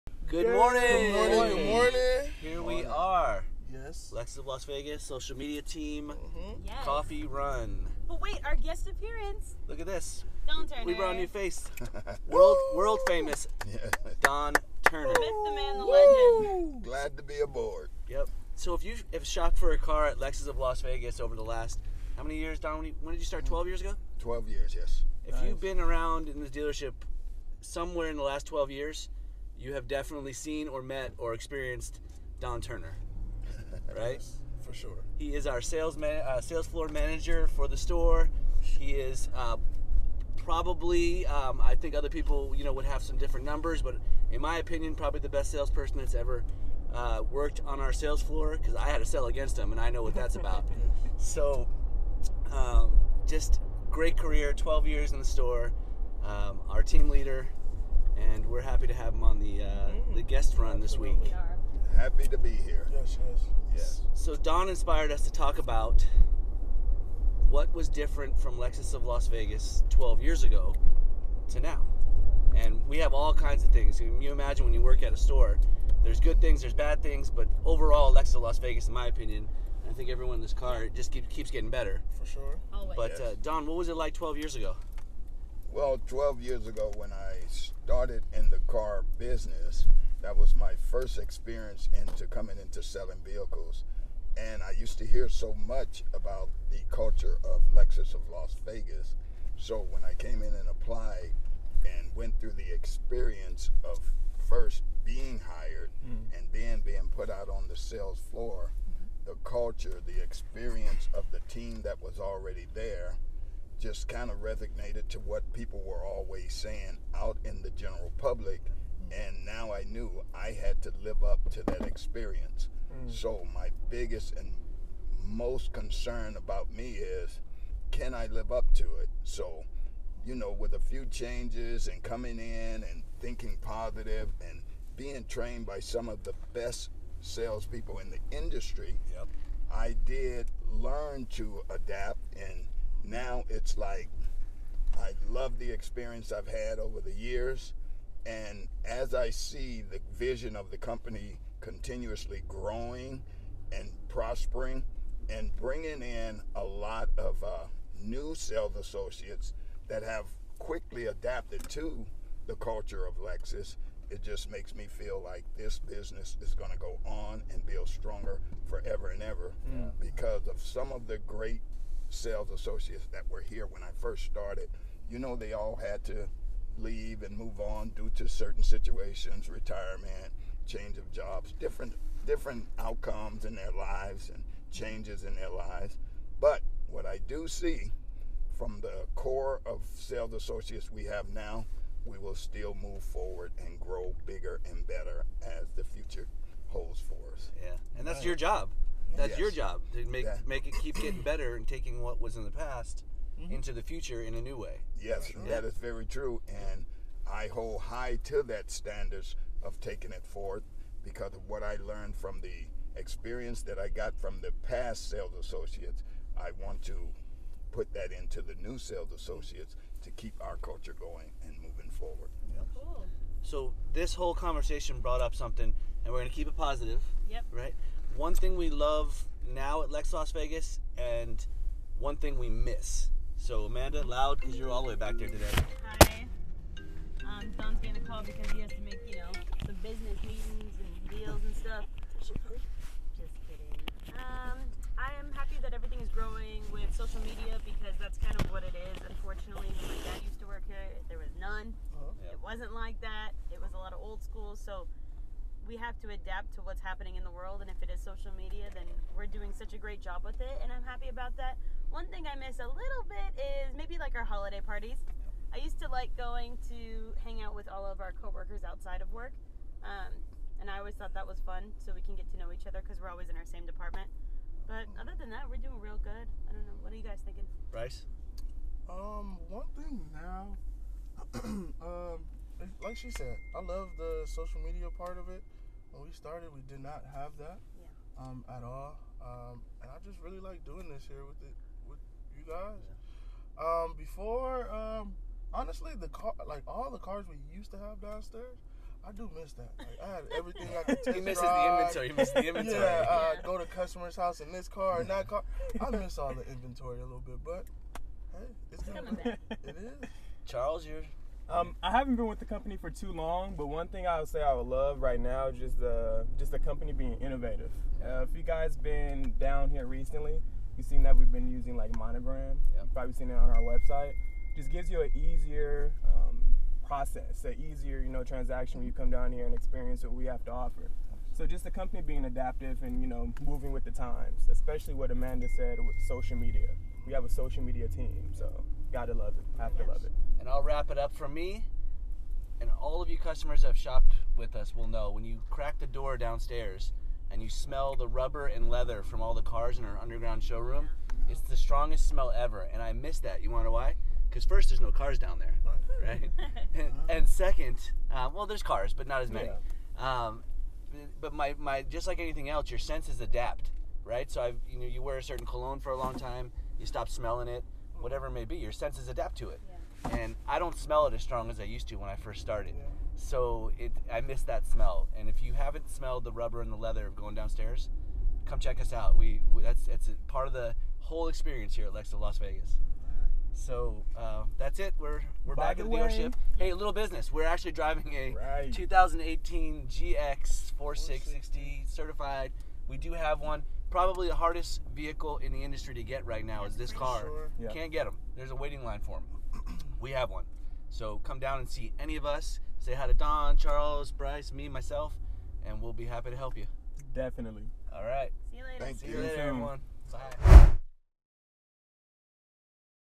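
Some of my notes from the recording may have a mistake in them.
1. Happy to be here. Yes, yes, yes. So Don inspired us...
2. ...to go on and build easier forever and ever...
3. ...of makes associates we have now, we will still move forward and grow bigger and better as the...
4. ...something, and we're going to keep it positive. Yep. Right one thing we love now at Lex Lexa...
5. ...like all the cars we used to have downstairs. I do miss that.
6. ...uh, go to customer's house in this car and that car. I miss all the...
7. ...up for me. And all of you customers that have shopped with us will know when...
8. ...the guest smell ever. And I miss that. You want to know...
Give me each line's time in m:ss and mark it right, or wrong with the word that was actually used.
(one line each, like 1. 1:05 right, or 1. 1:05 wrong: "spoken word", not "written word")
1. 1:01 right
2. 2:46 wrong: "stronger", not "easier"
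3. 3:09 wrong: "sales", not "makes"
4. 3:45 wrong: "Las", not "Lexa"
5. 4:56 right
6. 5:03 right
7. 5:40 right
8. 5:51 wrong: "strongest", not "guest".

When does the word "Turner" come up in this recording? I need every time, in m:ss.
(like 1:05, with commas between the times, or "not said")
0:10, 0:14, 0:32.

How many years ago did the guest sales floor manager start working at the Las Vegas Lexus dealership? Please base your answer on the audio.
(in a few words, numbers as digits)
12.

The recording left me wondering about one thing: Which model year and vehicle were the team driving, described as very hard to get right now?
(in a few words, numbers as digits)
2018 GX 460.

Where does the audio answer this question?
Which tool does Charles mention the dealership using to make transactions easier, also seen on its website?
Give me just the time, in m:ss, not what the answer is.
5:21.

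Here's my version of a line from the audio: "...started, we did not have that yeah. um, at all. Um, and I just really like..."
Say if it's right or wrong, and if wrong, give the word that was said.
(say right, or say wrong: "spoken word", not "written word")
right.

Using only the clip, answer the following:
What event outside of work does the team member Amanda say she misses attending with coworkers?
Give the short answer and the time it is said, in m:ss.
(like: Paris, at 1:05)
Holiday parties, at 4:24.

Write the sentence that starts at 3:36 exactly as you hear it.
I want to put that into the new sales associates to keep our culture going and moving forward.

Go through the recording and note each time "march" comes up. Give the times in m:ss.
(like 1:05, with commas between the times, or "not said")
not said.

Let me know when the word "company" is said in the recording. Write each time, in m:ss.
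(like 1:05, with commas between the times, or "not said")
2:30, 5:12, 5:16, 5:31.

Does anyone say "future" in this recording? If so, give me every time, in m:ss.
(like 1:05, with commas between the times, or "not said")
3:15, 3:23.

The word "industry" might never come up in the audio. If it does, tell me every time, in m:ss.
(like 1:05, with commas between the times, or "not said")
2:18, 6:35.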